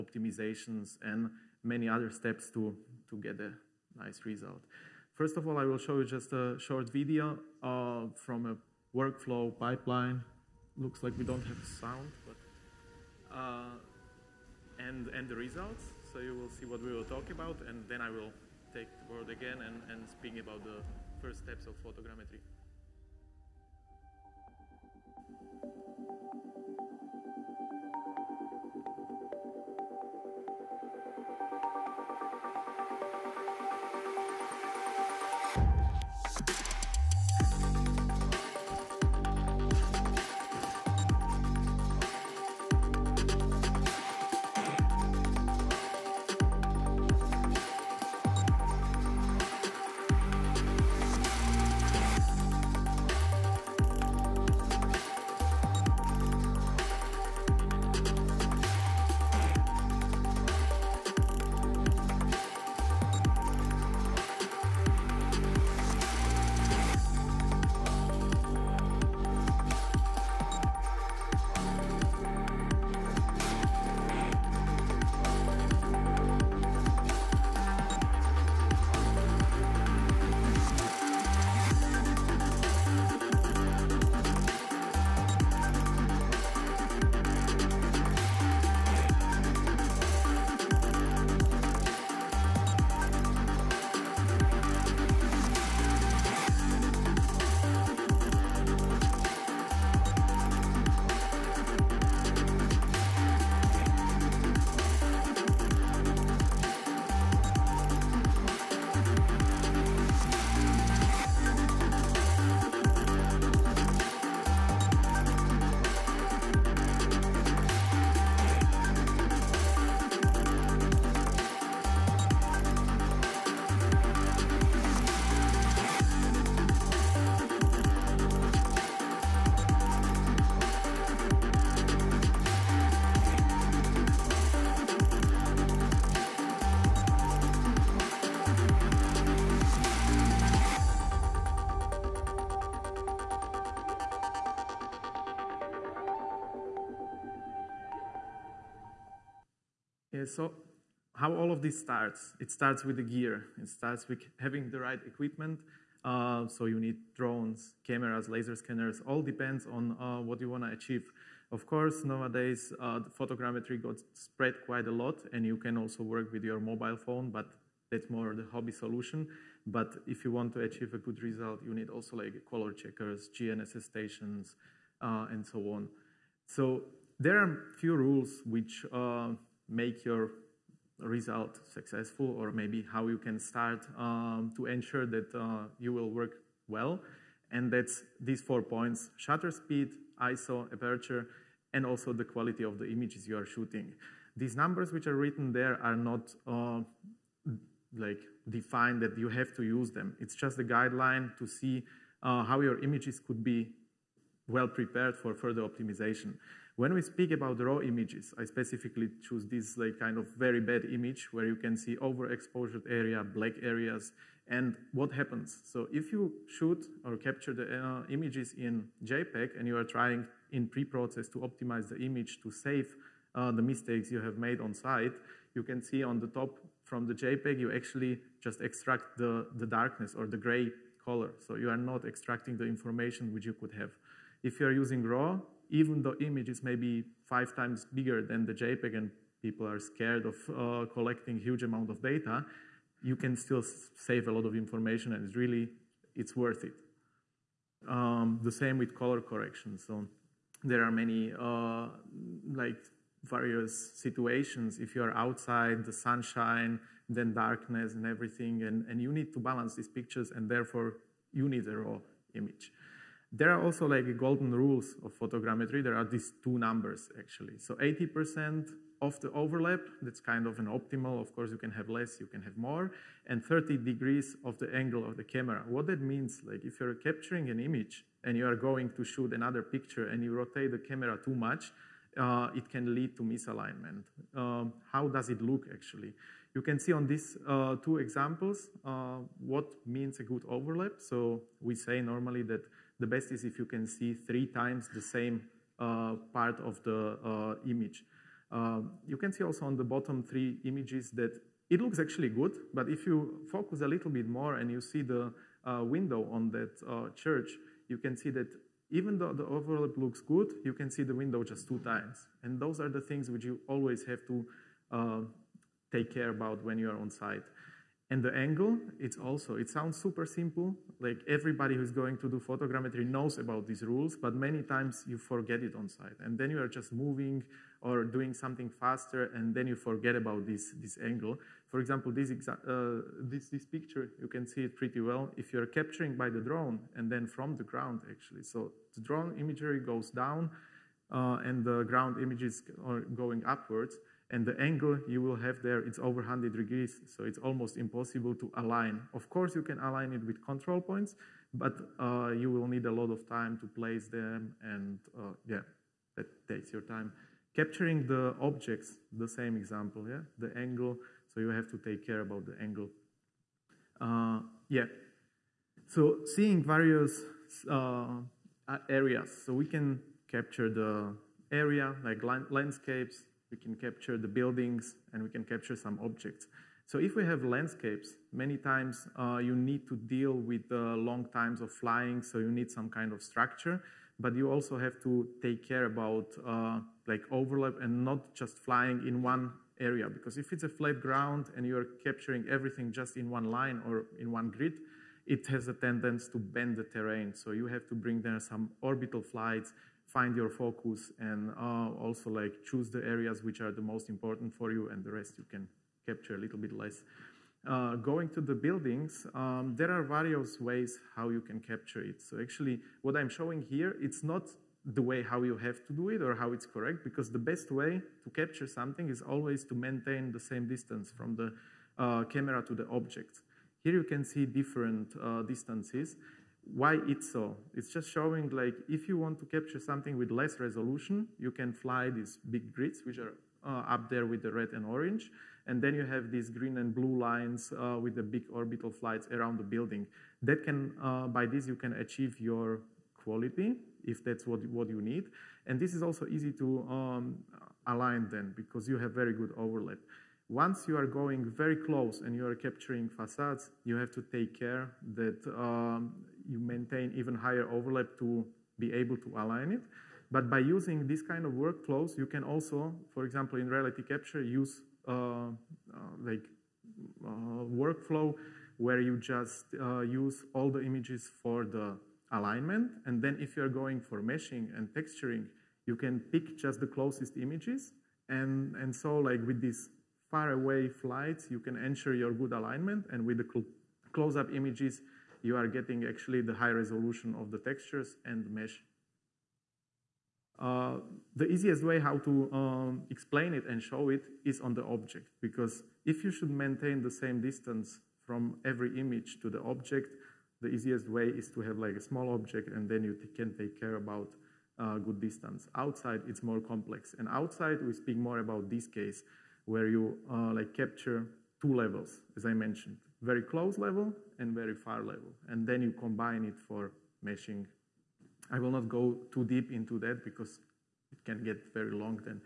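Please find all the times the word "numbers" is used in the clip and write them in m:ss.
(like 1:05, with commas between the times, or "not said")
3:14, 4:26.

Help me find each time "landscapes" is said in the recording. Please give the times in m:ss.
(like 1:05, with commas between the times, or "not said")
6:12, 6:17.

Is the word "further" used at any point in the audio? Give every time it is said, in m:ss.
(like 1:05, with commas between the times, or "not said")
3:25.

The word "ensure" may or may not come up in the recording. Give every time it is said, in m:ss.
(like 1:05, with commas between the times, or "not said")
3:04, 8:01.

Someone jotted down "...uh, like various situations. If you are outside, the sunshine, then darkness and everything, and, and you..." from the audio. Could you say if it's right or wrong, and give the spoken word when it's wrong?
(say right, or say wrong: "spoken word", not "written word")
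right.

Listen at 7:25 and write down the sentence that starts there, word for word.
And this is also easy to um, align then, because you have very good overlap.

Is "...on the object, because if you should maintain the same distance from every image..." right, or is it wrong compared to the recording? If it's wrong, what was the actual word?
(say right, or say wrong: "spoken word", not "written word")
right.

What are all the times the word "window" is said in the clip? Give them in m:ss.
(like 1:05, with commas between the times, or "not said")
5:05, 5:11.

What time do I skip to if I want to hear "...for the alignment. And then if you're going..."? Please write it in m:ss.
7:51.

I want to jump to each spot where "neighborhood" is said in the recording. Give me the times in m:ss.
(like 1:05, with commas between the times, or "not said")
not said.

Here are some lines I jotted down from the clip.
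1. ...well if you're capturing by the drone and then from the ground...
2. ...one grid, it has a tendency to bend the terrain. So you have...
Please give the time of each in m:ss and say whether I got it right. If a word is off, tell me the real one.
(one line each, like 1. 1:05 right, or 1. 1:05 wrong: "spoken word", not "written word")
1. 5:34 right
2. 6:34 right.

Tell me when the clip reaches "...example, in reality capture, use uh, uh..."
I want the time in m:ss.
7:43.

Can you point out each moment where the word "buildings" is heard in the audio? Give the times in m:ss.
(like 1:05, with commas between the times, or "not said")
6:14, 6:48, 7:19.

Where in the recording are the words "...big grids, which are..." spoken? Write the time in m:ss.
7:12.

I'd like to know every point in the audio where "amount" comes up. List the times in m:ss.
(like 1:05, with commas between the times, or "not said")
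4:01.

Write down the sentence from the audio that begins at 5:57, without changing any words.
Capturing the objects, the same example, yeah, the angle, so you have to take care about the angle.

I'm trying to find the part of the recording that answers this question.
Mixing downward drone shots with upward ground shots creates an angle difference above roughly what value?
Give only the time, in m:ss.
5:45.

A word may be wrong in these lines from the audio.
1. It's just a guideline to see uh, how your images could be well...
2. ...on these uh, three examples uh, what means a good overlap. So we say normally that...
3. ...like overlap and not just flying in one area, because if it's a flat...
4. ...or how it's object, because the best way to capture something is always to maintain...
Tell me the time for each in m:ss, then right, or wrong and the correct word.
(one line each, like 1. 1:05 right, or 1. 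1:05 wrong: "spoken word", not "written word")
1. 3:20 right
2. 4:46 wrong: "two", not "three"
3. 6:27 right
4. 6:56 wrong: "correct", not "object".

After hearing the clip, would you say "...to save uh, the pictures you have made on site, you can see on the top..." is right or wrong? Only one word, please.
wrong.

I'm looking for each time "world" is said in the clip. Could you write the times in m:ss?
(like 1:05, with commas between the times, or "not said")
not said.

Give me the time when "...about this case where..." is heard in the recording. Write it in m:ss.
8:28.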